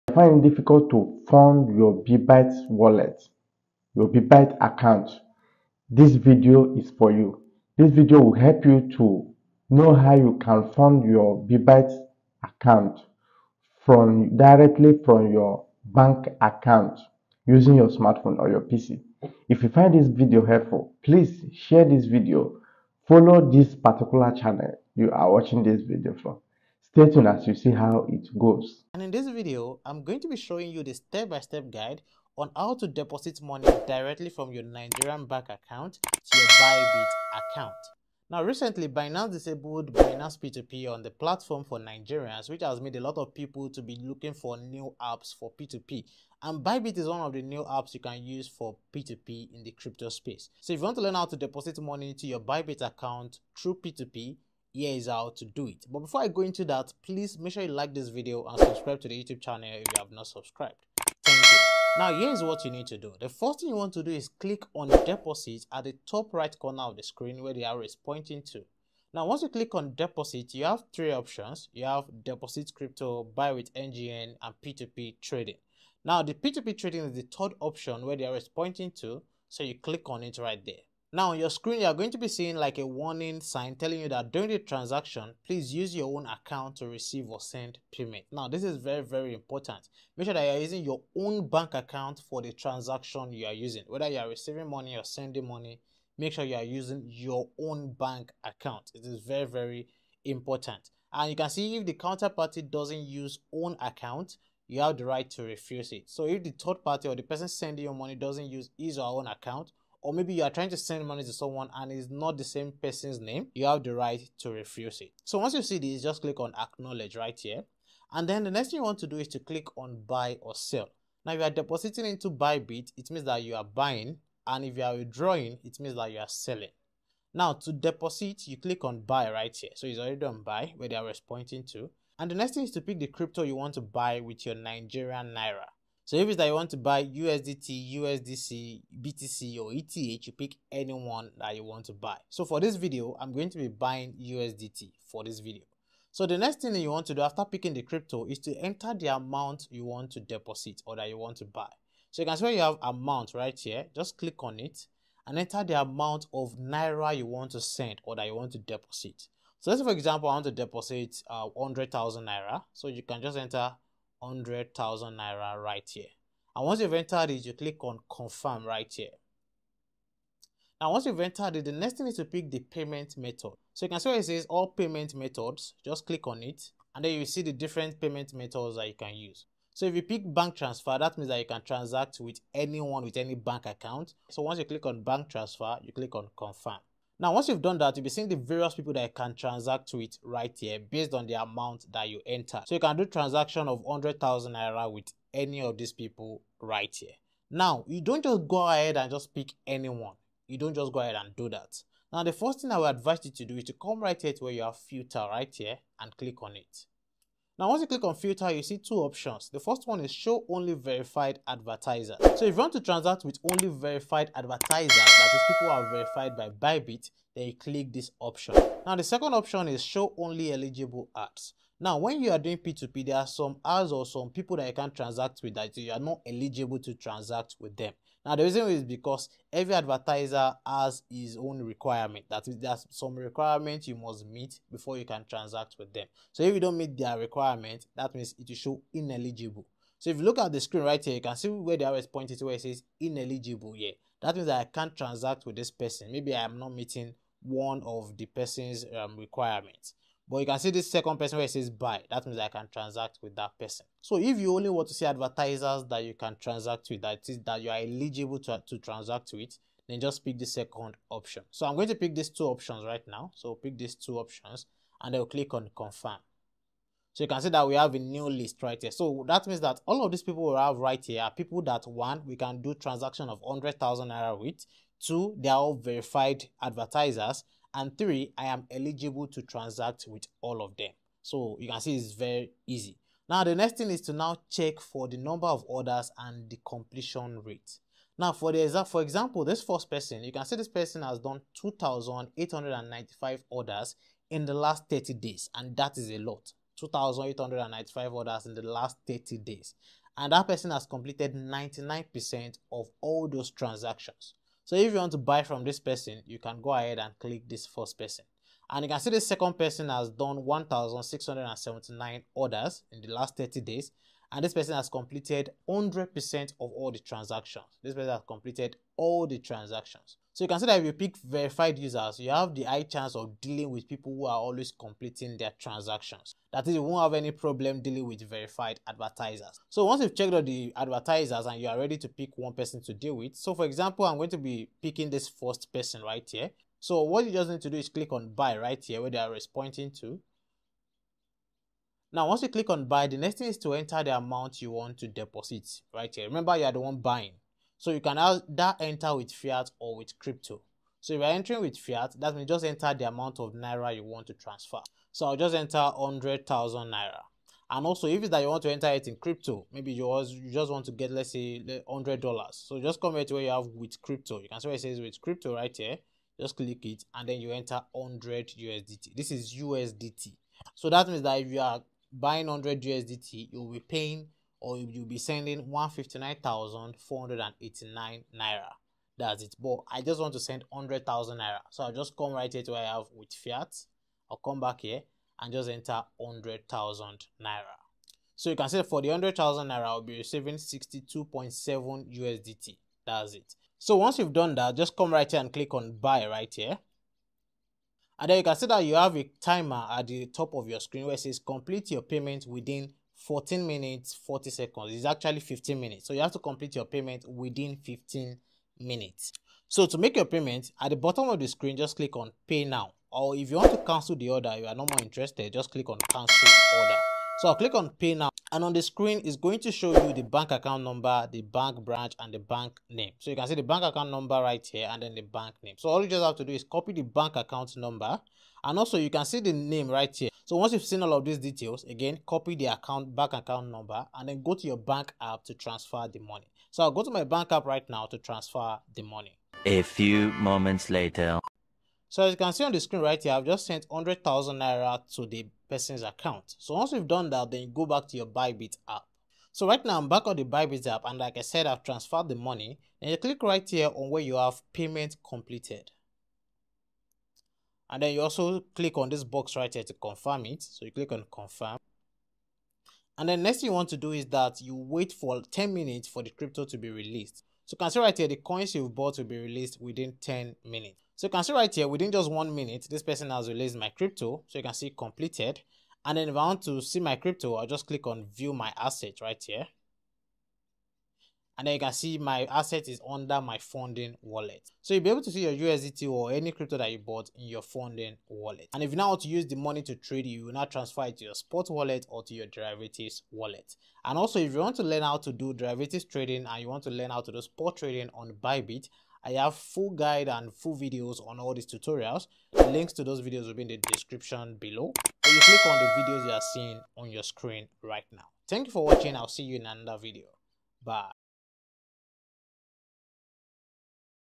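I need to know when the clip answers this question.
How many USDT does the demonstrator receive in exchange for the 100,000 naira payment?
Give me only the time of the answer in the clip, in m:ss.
6:30.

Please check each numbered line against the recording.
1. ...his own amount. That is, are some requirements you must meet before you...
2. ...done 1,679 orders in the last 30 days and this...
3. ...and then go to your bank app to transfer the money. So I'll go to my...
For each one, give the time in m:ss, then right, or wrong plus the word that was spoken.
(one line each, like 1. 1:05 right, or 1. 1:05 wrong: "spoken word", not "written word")
1. 3:51 wrong: "requirement", not "amount"
2. 5:10 right
3. 7:14 right.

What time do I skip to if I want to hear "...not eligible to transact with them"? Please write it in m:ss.
3:45.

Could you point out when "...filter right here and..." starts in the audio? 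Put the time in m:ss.
3:24.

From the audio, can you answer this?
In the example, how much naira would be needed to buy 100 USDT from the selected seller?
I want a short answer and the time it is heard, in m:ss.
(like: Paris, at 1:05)
159,489 naira, at 6:15.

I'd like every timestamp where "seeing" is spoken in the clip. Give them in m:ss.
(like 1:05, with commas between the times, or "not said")
1:22, 3:08, 8:26.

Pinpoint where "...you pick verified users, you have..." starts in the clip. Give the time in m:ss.
5:20.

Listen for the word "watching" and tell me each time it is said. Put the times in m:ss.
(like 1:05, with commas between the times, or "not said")
0:25, 8:28.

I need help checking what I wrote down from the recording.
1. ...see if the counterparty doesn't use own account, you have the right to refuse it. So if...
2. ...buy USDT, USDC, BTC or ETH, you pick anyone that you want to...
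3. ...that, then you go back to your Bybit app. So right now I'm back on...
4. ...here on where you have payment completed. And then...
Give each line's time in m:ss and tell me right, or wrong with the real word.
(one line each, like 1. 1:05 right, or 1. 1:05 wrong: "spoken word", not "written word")
1. 1:41 right
2. 2:16 right
3. 7:27 right
4. 7:33 right.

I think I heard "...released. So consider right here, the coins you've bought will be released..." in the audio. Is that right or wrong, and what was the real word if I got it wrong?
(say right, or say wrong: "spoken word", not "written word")
right.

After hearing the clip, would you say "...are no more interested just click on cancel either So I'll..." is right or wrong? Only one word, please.
wrong.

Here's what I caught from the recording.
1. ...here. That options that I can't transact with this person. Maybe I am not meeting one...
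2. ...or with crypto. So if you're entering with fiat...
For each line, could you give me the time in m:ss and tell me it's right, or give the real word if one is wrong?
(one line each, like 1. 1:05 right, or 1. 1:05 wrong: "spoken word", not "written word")
1. 4:03 wrong: "means", not "options"
2. 5:49 right.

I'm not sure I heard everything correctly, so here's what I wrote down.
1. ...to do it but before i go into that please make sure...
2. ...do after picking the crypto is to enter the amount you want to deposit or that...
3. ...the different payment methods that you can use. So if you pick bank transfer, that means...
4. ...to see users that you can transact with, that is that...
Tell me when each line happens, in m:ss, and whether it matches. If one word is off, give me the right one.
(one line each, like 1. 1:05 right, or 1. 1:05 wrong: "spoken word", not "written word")
1. 0:55 right
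2. 2:27 right
3. 2:57 right
4. 4:14 wrong: "advertisers", not "users".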